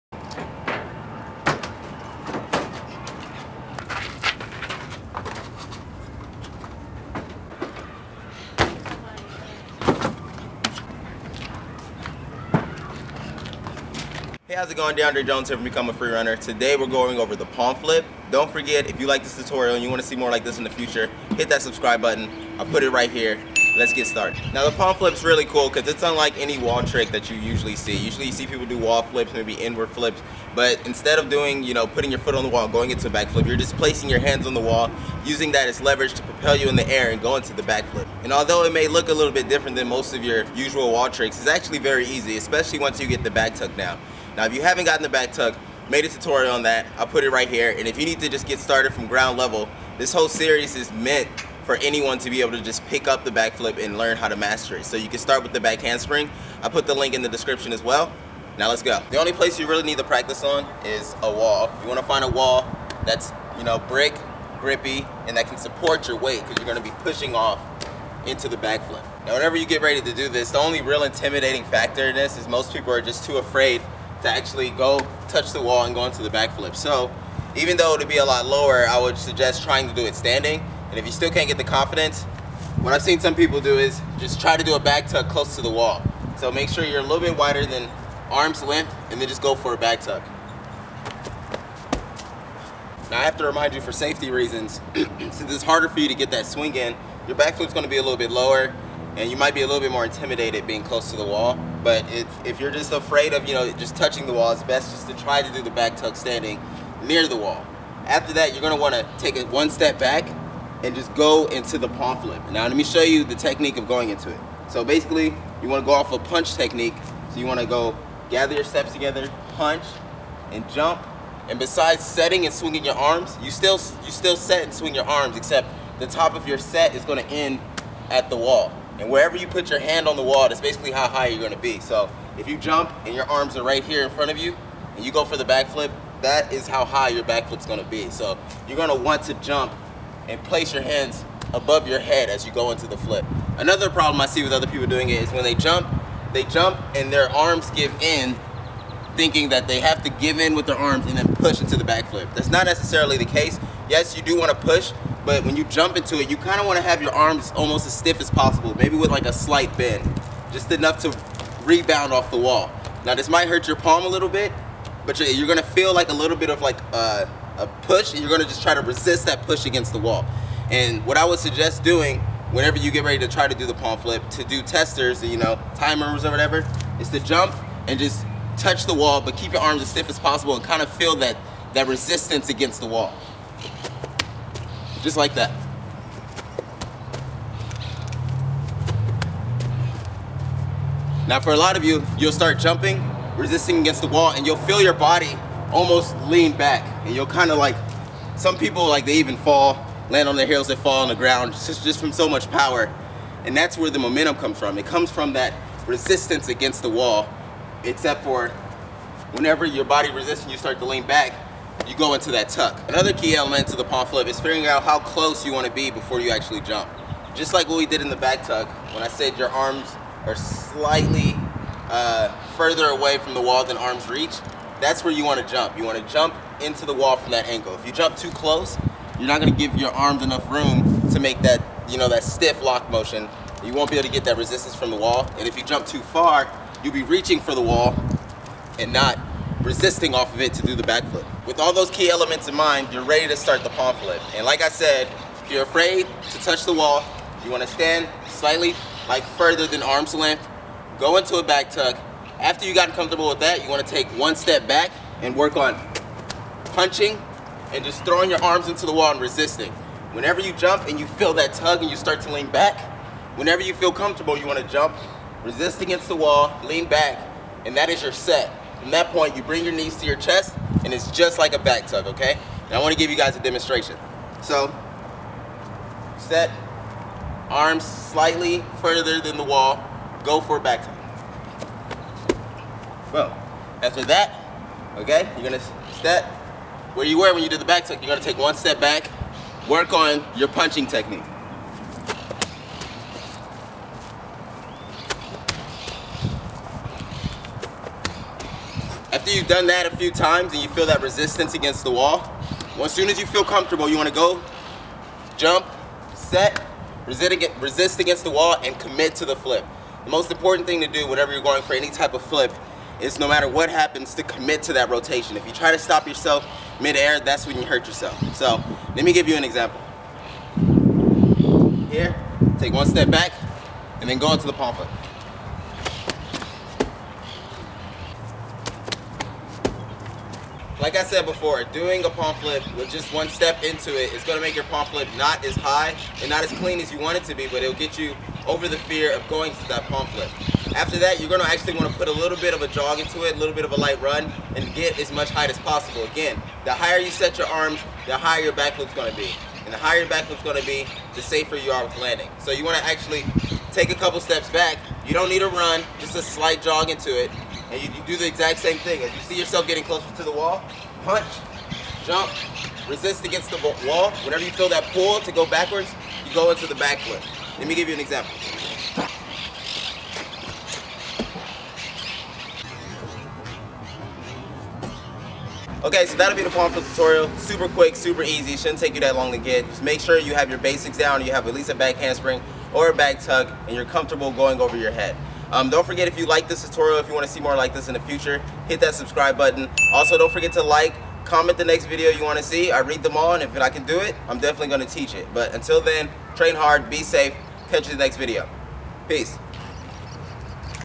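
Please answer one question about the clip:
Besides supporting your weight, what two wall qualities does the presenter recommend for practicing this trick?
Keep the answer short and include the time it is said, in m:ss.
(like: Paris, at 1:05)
brick, grippy, at 1:03.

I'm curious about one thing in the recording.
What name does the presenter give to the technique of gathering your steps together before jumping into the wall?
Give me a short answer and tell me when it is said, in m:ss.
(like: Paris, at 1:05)
punch technique, at 1:56.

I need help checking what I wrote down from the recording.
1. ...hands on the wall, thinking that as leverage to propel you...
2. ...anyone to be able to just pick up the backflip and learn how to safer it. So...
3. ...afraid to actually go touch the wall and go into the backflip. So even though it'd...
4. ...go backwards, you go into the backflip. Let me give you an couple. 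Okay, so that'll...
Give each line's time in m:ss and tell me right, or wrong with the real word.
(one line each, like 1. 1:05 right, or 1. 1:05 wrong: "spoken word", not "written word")
1. 0:34 wrong: "using", not "thinking"
2. 0:51 wrong: "master", not "safer"
3. 1:13 right
4. 6:05 wrong: "example", not "couple".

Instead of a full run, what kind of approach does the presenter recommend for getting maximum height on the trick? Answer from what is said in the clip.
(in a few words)
a slight jog.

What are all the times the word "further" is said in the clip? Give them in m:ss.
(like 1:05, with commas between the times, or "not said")
3:42, 4:09, 4:38.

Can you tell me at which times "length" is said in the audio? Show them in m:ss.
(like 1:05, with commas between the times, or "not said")
1:28, 4:10.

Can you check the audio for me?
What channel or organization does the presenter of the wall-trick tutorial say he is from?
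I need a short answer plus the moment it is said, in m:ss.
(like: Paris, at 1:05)
Become a Freerunner, at 0:15.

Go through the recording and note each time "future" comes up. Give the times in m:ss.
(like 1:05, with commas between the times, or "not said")
0:20, 6:28.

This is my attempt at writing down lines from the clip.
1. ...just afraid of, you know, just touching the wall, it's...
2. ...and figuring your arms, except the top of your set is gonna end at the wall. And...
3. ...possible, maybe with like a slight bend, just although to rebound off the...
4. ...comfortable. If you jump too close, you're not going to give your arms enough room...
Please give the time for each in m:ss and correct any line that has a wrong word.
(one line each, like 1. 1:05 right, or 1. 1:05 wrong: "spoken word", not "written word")
1. 1:42 right
2. 2:04 wrong: "swing", not "figuring"
3. 2:38 wrong: "enough", not "although"
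4. 3:47 wrong: "angle", not "comfortable".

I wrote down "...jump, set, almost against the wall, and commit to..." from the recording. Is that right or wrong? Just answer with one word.
wrong.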